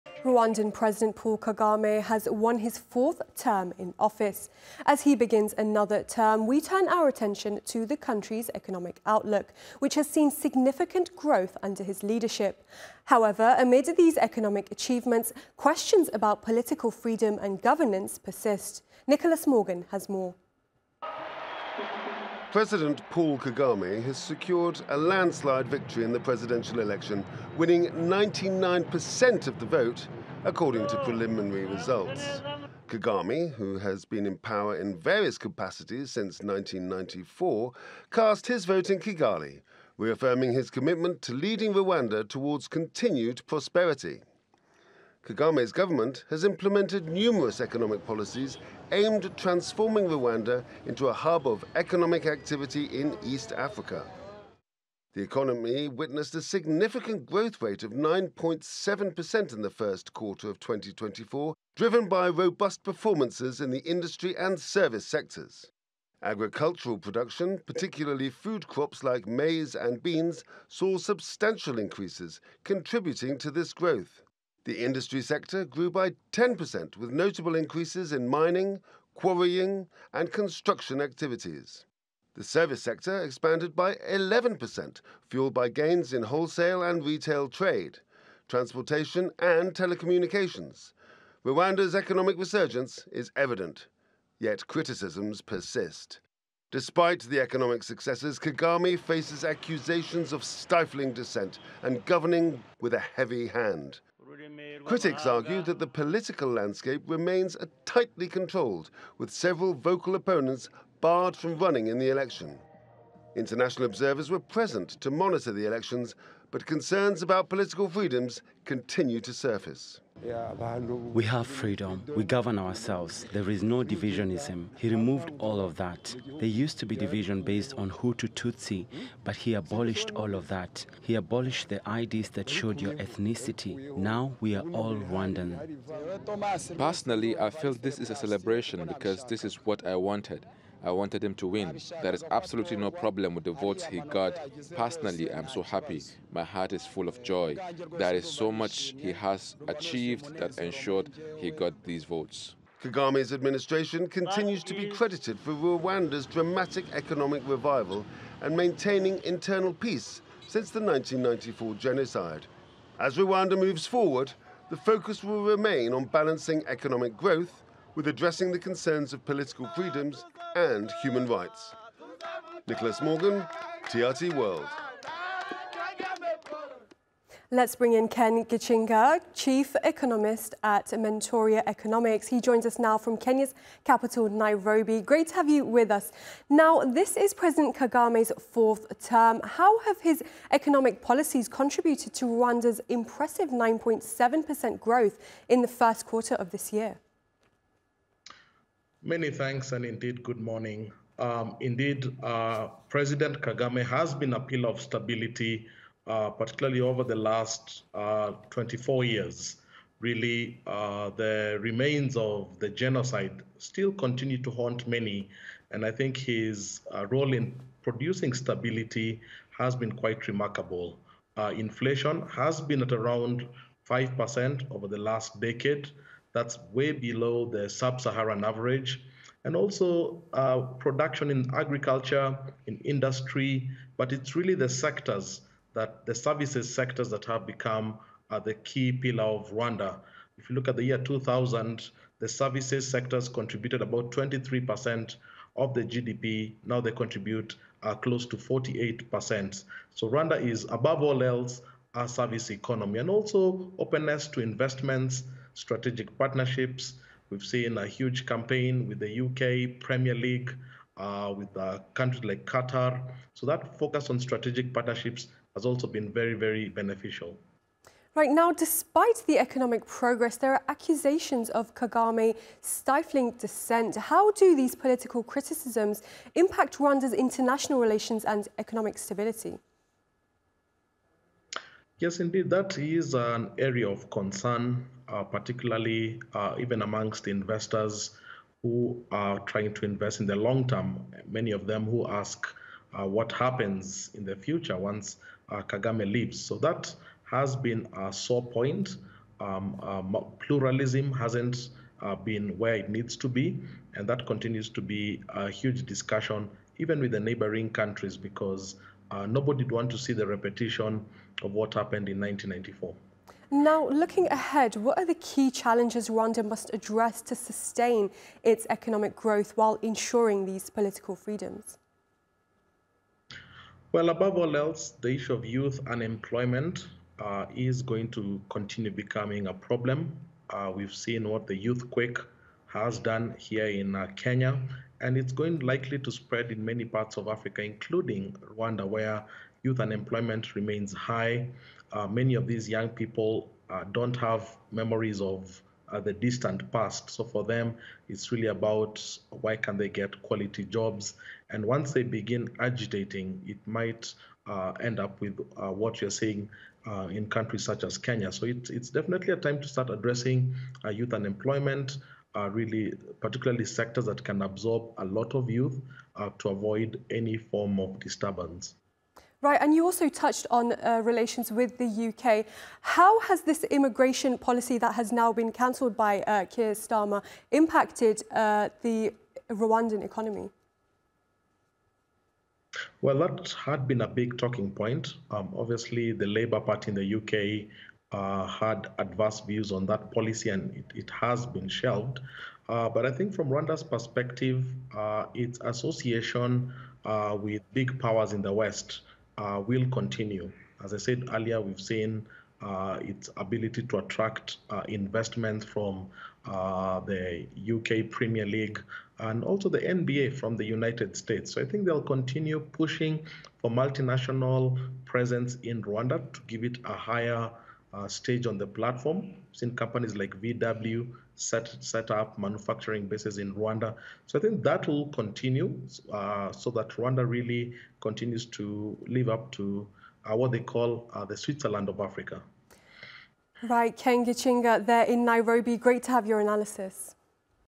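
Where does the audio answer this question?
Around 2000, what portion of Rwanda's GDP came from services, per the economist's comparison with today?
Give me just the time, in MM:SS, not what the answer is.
04:04.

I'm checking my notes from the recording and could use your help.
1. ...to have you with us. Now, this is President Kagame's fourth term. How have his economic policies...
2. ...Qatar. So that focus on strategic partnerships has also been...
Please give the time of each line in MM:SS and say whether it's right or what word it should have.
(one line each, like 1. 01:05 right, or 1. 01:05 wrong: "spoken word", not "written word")
1. 03:05 right
2. 04:22 right.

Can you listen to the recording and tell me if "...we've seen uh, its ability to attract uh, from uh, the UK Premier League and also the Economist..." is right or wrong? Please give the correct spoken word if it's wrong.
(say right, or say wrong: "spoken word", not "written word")
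wrong: "NBA", not "Economist".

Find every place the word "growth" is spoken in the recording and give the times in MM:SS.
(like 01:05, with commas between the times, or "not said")
00:11, 00:57, 01:13, 02:47, 03:14, 05:19.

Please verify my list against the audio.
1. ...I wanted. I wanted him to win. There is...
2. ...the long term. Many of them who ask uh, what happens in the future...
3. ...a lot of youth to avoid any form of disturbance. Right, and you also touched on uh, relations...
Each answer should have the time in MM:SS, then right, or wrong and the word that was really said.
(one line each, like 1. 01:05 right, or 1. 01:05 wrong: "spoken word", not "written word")
1. 02:19 right
2. 04:50 right
3. 06:04 right.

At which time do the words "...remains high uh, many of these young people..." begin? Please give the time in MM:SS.
05:40.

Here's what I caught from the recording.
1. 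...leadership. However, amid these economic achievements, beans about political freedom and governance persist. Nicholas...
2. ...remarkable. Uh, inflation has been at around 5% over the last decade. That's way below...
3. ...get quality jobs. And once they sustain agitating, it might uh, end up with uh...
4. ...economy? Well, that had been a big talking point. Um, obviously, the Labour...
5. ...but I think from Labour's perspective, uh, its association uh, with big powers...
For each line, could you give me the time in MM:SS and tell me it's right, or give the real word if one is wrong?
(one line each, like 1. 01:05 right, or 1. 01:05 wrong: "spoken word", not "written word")
1. 00:12 wrong: "questions", not "beans"
2. 03:40 right
3. 05:49 wrong: "begin", not "sustain"
4. 06:20 right
5. 06:32 wrong: "Rwanda", not "Labour".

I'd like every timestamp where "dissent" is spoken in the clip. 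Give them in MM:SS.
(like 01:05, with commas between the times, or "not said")
01:41, 04:33.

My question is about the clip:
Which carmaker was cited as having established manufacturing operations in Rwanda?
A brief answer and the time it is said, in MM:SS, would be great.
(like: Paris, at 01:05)
VW, at 07:00.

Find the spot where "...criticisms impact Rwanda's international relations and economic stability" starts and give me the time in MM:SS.
04:35.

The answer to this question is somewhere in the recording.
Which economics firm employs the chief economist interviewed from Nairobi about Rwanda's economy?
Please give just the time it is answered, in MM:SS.
03:00.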